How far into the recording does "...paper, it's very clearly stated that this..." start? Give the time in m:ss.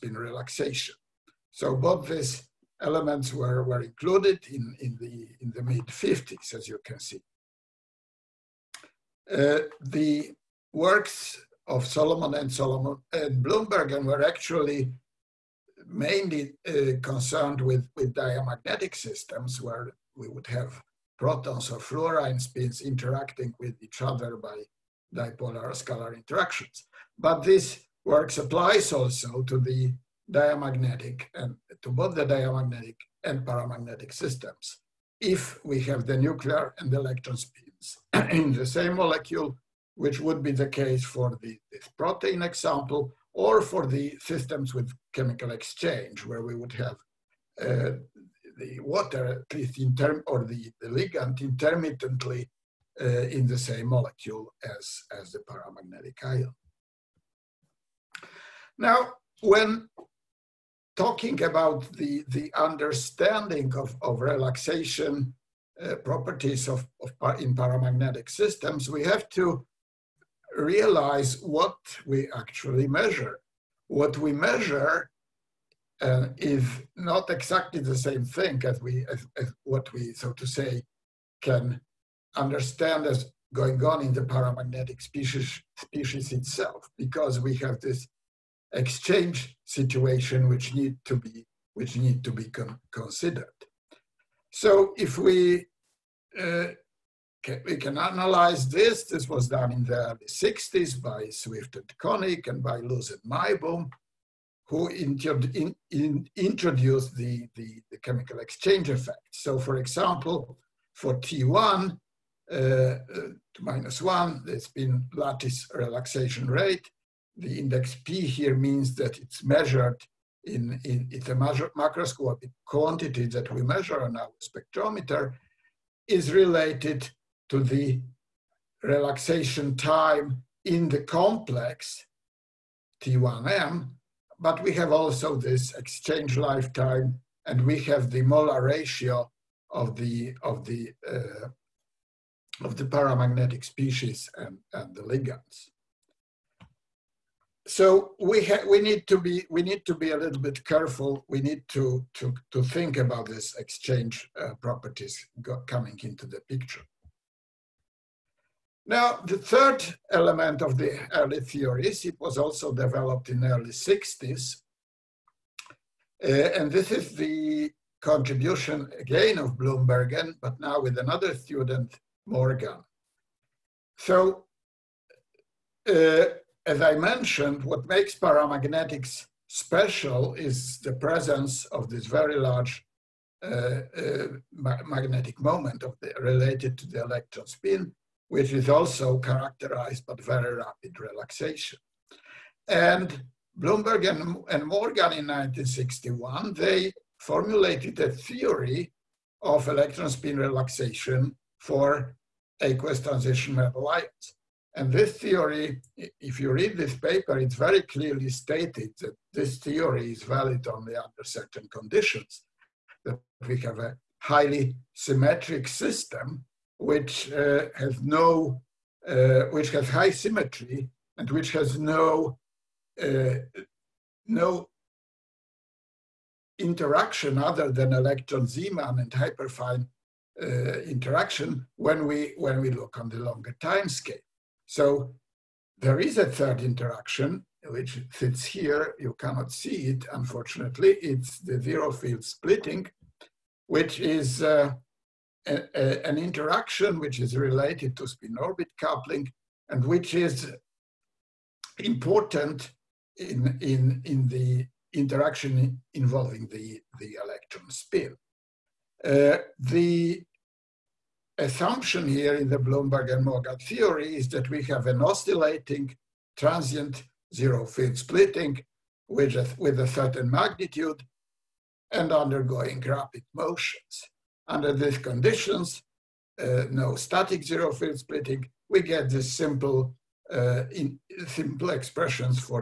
3:26.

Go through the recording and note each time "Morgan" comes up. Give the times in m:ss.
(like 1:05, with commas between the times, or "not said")
2:52, 3:14, 4:23.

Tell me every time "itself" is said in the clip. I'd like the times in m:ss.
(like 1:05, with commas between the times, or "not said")
1:26.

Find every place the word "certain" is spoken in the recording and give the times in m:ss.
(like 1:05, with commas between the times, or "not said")
3:31, 4:29.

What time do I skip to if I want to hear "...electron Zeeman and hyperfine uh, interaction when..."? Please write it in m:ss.
3:47.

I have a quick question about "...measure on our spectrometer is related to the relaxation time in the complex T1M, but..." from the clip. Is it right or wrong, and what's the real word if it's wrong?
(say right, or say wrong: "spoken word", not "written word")
right.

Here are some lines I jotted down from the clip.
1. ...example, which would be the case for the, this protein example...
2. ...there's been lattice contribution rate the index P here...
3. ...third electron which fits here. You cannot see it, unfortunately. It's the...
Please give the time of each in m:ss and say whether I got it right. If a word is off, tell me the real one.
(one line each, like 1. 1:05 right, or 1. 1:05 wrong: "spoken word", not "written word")
1. 0:38 wrong: "molecule", not "example"
2. 1:54 wrong: "relaxation", not "contribution"
3. 3:56 wrong: "interaction", not "electron".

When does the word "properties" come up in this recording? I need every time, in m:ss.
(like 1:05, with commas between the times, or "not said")
1:05, 2:34.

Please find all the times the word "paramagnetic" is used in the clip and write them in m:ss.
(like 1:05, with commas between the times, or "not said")
0:33, 0:55, 1:07, 1:24, 2:22, 2:58.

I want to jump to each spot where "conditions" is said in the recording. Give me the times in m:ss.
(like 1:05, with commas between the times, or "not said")
3:31, 4:34.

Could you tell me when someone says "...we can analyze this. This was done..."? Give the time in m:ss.
1:37.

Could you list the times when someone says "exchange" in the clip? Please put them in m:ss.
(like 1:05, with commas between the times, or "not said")
0:45, 1:28, 1:48, 2:15, 2:33.